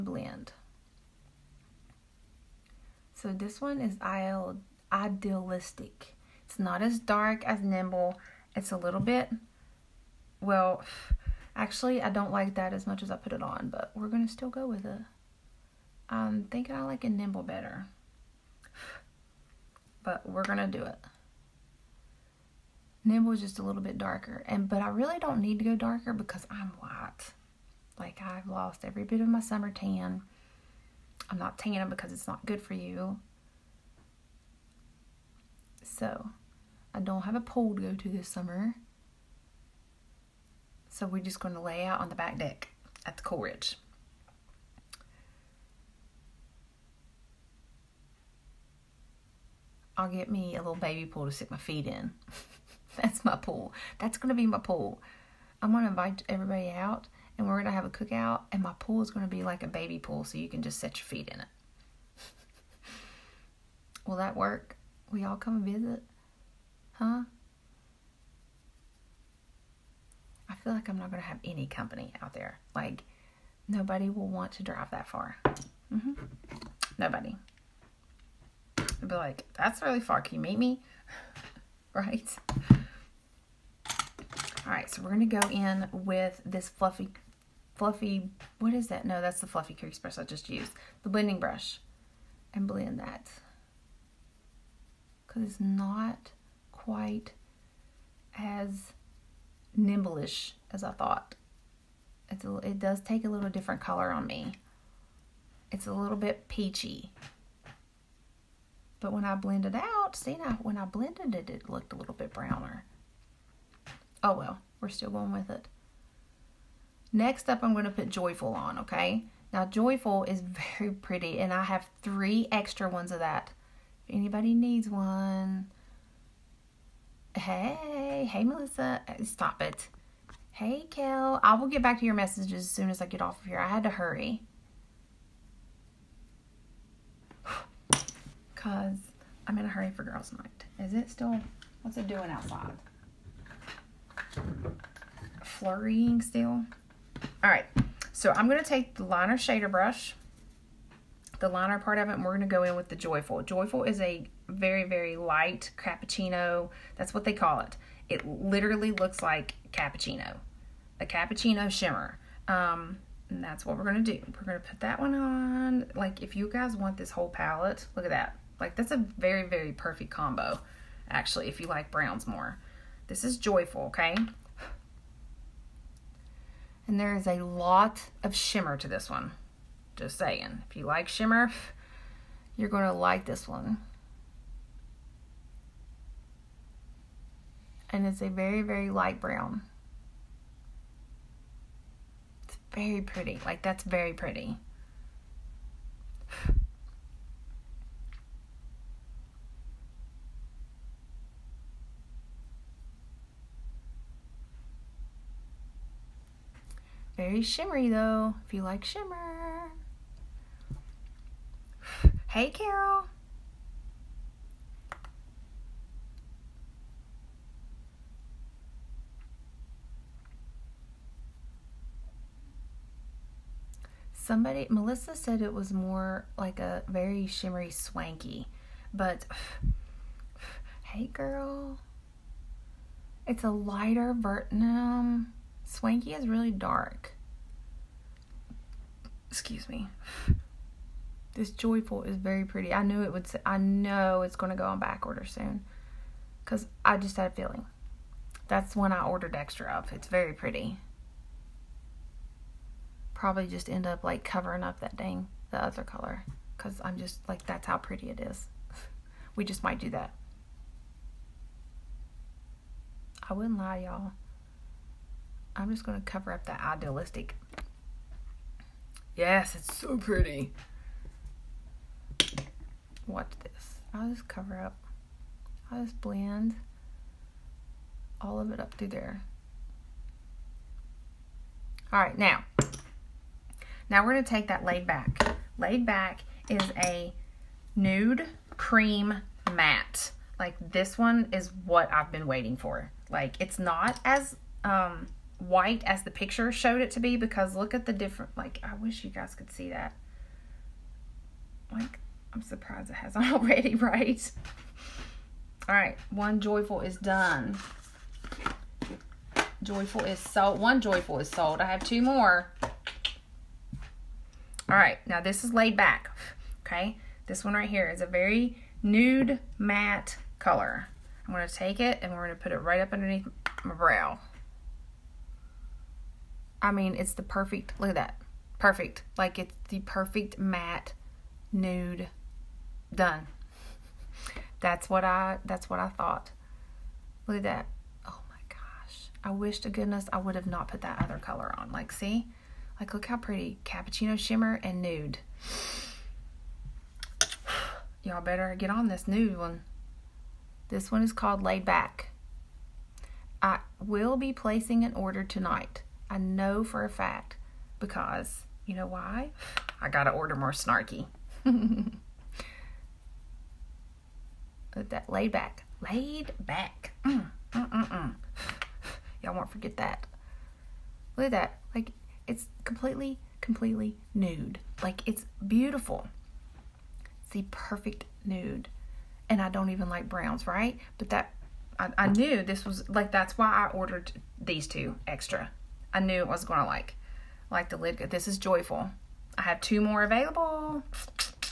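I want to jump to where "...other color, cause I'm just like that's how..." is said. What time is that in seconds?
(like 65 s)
255 s.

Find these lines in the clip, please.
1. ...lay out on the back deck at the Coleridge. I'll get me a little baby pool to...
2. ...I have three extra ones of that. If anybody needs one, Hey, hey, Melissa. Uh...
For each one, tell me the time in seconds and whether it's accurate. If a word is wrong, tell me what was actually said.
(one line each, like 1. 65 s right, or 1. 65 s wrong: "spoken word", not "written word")
1. 41 s right
2. 121 s right.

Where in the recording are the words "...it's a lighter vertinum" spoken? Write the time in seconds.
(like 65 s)
233 s.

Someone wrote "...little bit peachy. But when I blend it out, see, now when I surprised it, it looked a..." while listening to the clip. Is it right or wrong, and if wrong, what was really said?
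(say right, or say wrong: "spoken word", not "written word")
wrong: "blended", not "surprised".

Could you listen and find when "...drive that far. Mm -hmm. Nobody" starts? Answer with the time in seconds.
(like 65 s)
74 s.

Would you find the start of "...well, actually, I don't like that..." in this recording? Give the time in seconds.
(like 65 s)
10 s.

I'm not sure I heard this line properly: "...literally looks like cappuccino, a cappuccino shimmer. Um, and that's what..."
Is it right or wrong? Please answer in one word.
right.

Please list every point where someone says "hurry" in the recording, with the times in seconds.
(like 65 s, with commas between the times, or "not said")
133 s, 139 s.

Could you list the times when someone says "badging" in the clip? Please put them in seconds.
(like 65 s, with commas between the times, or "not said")
not said.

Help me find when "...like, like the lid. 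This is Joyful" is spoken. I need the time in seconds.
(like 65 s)
386 s.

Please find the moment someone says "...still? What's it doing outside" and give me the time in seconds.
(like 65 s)
141 s.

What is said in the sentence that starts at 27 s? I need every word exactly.
Like, I've lost every bit of my summer tan.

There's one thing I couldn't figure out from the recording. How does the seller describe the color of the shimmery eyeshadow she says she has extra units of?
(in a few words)
light cappuccino.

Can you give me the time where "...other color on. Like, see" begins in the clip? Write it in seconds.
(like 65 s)
341 s.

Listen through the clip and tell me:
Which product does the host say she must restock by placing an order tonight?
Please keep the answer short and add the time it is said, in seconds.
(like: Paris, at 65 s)
Snarky, at 360 s.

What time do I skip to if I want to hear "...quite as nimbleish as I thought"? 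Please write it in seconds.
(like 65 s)
96 s.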